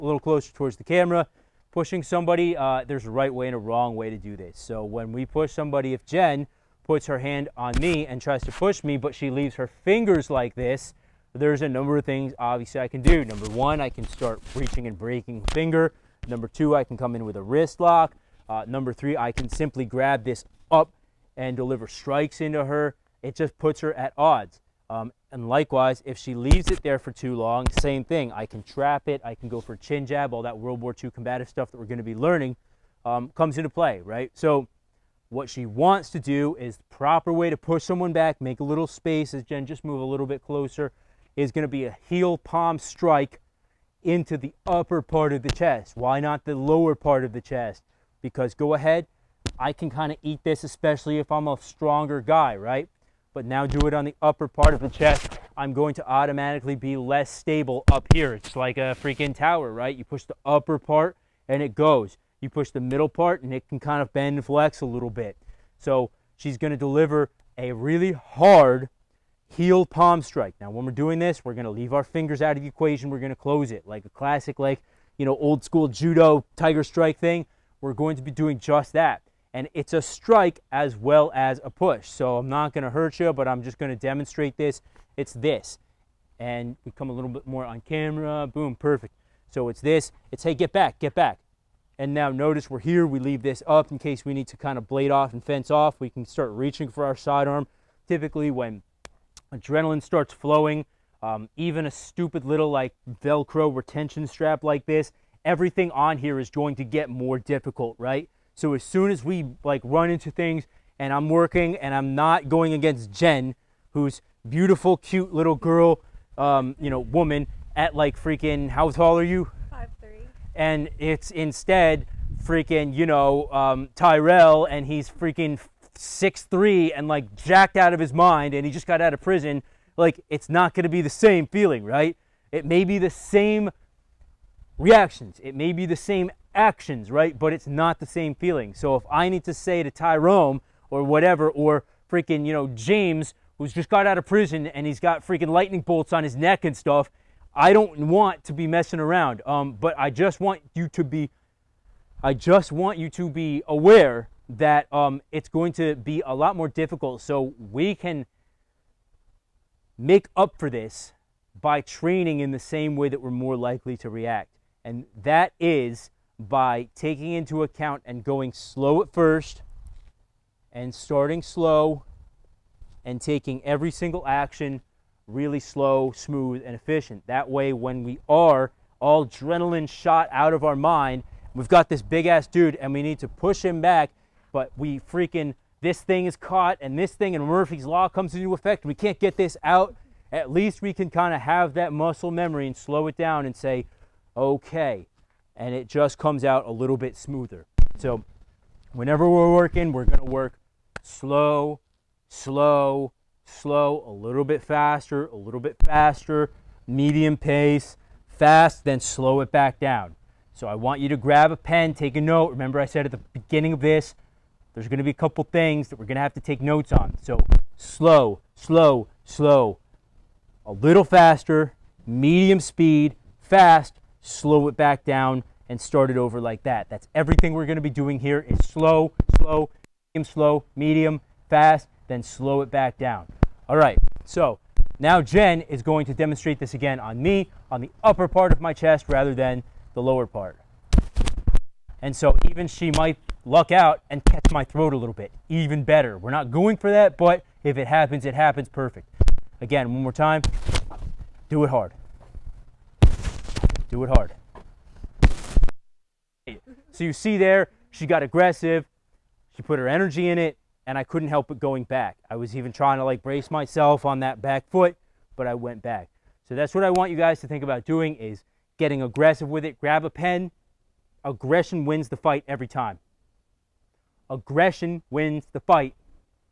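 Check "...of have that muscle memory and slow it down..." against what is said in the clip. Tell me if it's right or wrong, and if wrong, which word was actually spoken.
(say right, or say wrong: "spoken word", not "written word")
right.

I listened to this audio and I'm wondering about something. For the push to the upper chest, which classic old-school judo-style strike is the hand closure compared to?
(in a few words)
Tiger strike.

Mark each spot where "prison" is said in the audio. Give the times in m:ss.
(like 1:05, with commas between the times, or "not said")
2:09, 2:24.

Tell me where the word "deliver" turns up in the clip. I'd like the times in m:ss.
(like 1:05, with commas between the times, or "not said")
0:21, 1:06.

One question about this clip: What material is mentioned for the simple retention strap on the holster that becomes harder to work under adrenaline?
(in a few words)
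Velcro.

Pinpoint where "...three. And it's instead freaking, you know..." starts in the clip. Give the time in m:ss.
2:00.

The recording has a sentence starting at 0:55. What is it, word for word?
I'm going to automatically be less stable up here.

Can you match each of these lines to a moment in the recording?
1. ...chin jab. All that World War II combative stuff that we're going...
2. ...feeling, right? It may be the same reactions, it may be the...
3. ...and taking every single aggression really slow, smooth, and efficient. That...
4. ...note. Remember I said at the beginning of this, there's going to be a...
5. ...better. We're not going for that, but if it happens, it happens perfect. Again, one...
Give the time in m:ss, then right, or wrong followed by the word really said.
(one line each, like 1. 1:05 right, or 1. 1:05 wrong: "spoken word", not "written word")
1. 0:29 right
2. 2:11 right
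3. 2:53 wrong: "action", not "aggression"
4. 3:32 right
5. 4:05 right.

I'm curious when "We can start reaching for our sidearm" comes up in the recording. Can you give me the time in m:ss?
1:35.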